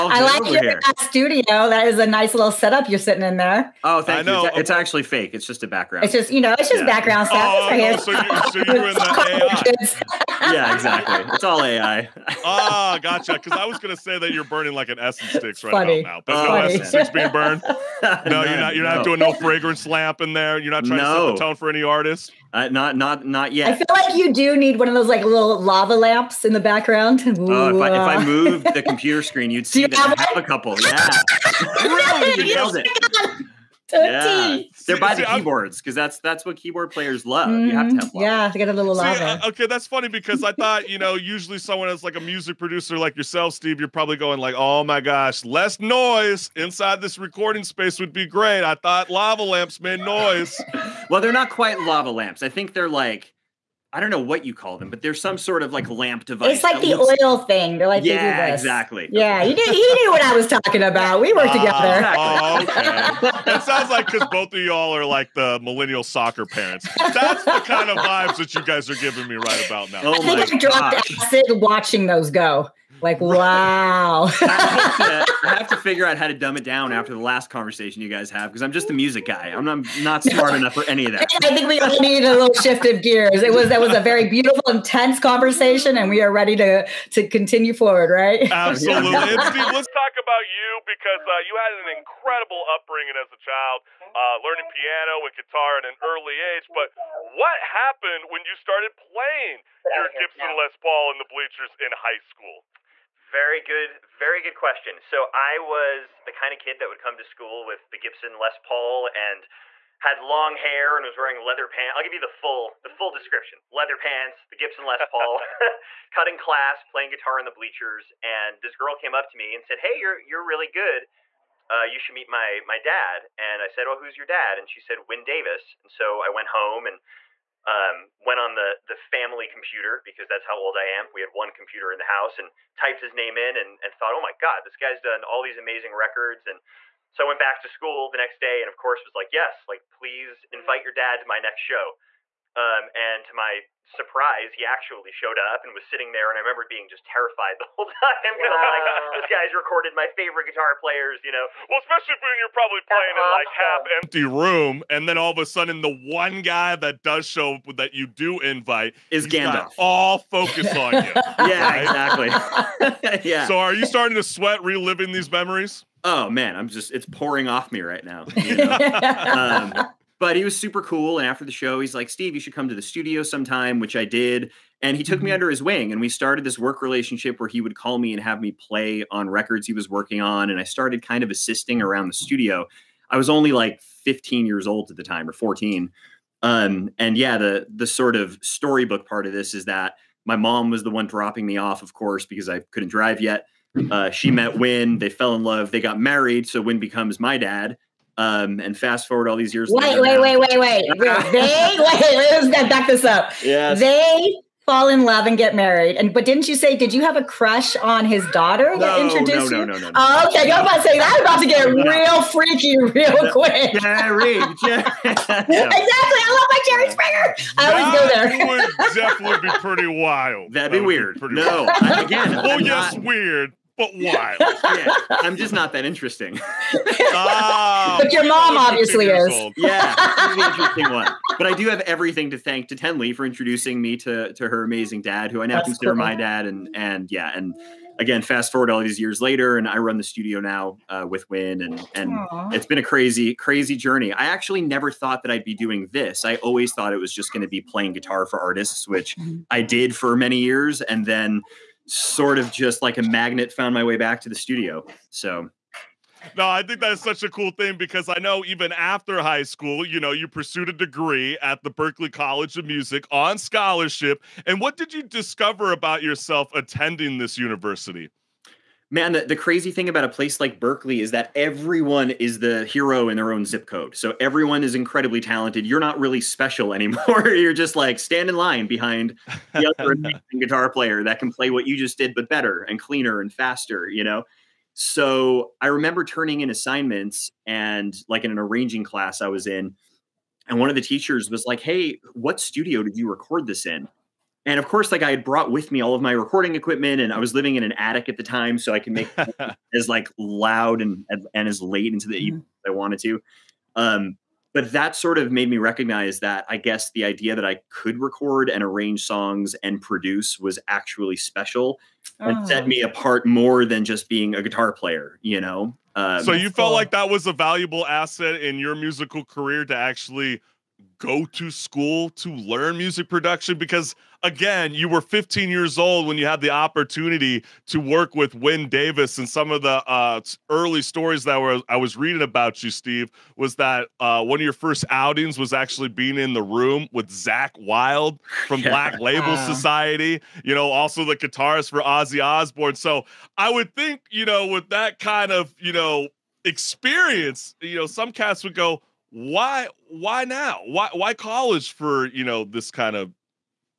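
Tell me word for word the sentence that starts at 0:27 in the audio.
uh, if, I, if I moved the computer screen, you'd see that I have a couple.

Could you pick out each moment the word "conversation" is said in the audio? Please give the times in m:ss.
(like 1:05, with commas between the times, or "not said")
1:17, 1:25.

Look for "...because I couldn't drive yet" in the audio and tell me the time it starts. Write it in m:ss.
3:12.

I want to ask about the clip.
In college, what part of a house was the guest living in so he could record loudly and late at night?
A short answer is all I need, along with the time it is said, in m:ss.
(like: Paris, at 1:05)
attic, at 4:57.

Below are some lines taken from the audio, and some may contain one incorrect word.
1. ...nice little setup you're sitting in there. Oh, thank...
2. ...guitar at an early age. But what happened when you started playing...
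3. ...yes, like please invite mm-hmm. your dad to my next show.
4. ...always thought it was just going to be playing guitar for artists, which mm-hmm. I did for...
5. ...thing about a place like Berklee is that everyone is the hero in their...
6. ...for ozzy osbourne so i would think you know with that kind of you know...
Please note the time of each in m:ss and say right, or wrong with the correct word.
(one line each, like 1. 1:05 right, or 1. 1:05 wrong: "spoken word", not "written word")
1. 0:02 right
2. 1:35 right
3. 2:19 right
4. 4:06 right
5. 4:29 right
6. 5:41 right.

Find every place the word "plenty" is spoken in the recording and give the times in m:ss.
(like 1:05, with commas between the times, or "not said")
not said.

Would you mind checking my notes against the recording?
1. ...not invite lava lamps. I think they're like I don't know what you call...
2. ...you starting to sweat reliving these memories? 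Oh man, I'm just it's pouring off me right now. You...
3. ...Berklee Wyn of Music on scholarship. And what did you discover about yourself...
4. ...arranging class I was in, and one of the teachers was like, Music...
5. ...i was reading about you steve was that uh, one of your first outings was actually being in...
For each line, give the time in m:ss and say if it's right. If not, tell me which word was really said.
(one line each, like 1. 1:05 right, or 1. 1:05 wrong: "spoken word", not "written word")
1. 0:51 wrong: "quite", not "invite"
2. 2:43 right
3. 4:21 wrong: "College", not "Wyn"
4. 4:48 wrong: "Hey", not "Music"
5. 5:31 right.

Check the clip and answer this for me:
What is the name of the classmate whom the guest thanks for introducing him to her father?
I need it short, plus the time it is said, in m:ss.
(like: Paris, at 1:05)
Tenley, at 3:52.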